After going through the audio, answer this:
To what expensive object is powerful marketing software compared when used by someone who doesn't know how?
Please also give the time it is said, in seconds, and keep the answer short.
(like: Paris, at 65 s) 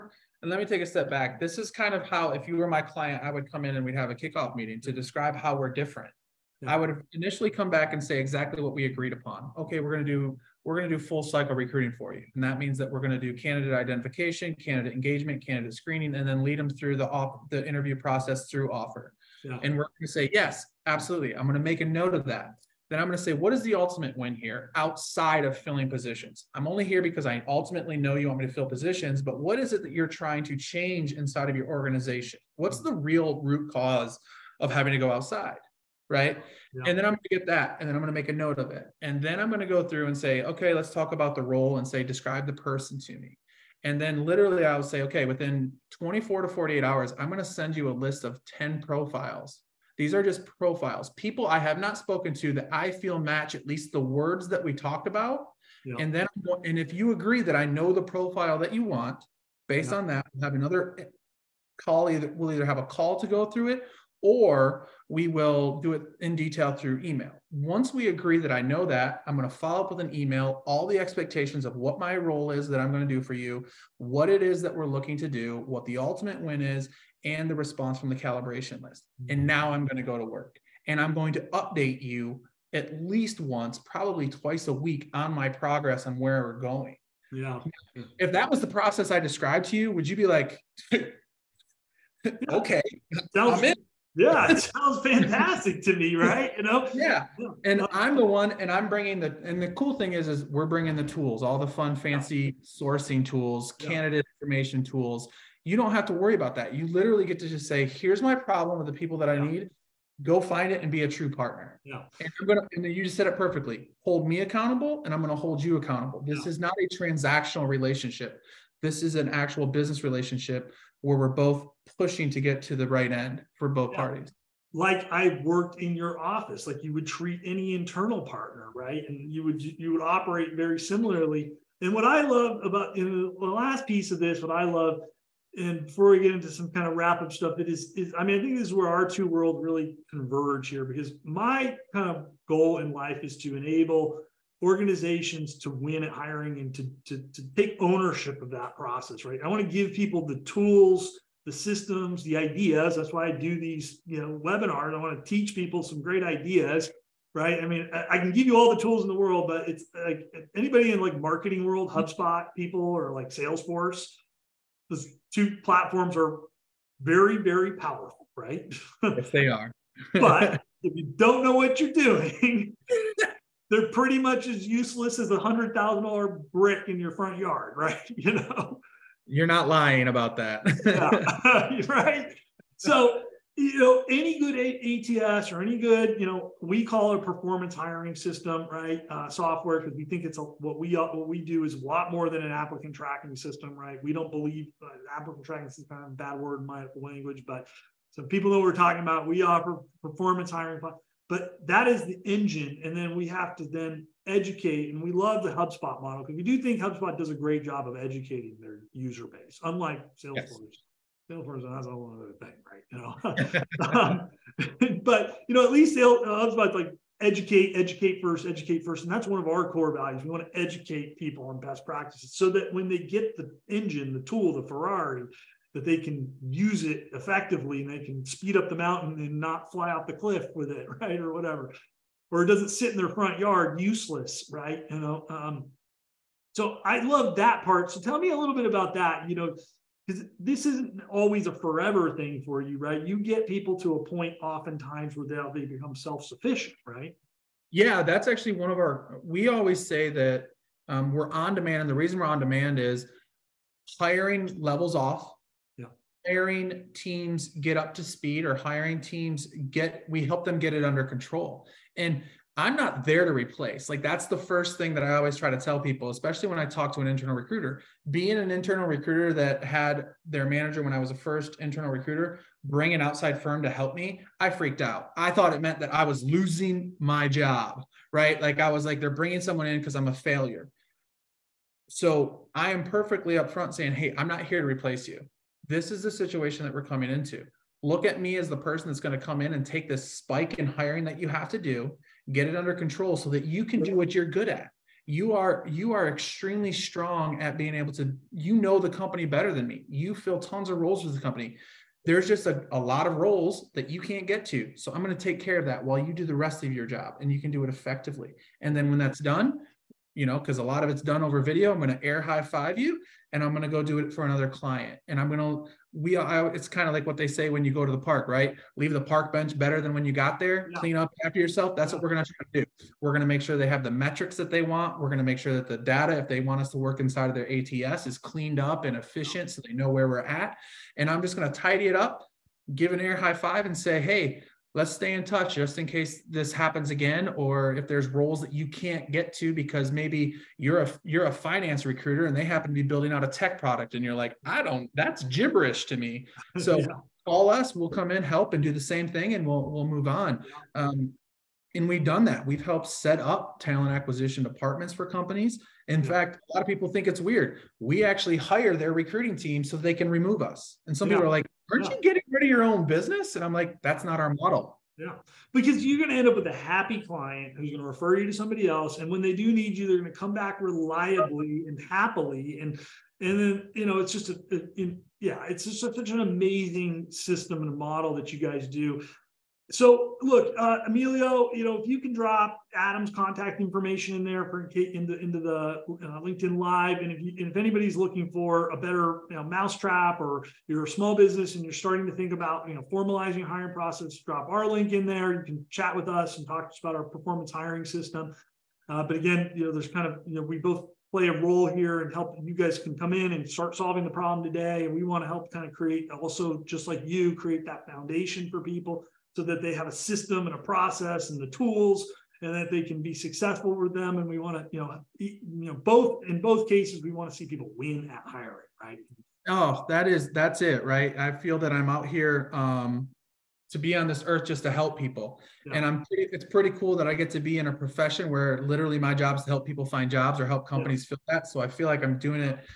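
a hundred thousand dollar brick, at 175 s.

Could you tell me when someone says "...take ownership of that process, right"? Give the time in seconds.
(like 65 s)
147 s.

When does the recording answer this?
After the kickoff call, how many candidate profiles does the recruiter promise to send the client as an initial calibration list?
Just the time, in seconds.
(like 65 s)
48 s.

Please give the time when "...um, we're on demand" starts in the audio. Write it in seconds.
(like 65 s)
250 s.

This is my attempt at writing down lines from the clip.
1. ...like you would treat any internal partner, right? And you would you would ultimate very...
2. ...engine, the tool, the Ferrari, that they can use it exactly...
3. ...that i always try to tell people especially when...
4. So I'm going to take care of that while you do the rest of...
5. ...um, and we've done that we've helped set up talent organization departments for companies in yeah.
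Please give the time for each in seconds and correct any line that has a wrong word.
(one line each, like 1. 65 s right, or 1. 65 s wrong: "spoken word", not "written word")
1. 126 s wrong: "operate", not "ultimate"
2. 223 s wrong: "effectively", not "exactly"
3. 264 s right
4. 304 s right
5. 350 s wrong: "acquisition", not "organization".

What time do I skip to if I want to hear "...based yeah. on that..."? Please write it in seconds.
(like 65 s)
59 s.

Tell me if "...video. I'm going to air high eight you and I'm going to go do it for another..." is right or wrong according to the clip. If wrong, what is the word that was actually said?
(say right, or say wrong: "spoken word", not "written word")
wrong: "five", not "eight".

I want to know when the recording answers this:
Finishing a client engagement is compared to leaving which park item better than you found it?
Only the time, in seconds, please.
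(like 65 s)
318 s.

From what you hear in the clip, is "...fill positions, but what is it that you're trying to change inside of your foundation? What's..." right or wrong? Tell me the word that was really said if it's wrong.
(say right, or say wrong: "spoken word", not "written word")
wrong: "organization", not "foundation".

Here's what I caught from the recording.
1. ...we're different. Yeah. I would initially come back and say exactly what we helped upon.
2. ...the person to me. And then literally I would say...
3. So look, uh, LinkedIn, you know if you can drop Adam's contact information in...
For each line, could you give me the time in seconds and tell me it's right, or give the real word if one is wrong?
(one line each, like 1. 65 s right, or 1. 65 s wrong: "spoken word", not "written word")
1. 5 s wrong: "agreed", not "helped"
2. 42 s right
3. 379 s wrong: "Emilio", not "LinkedIn".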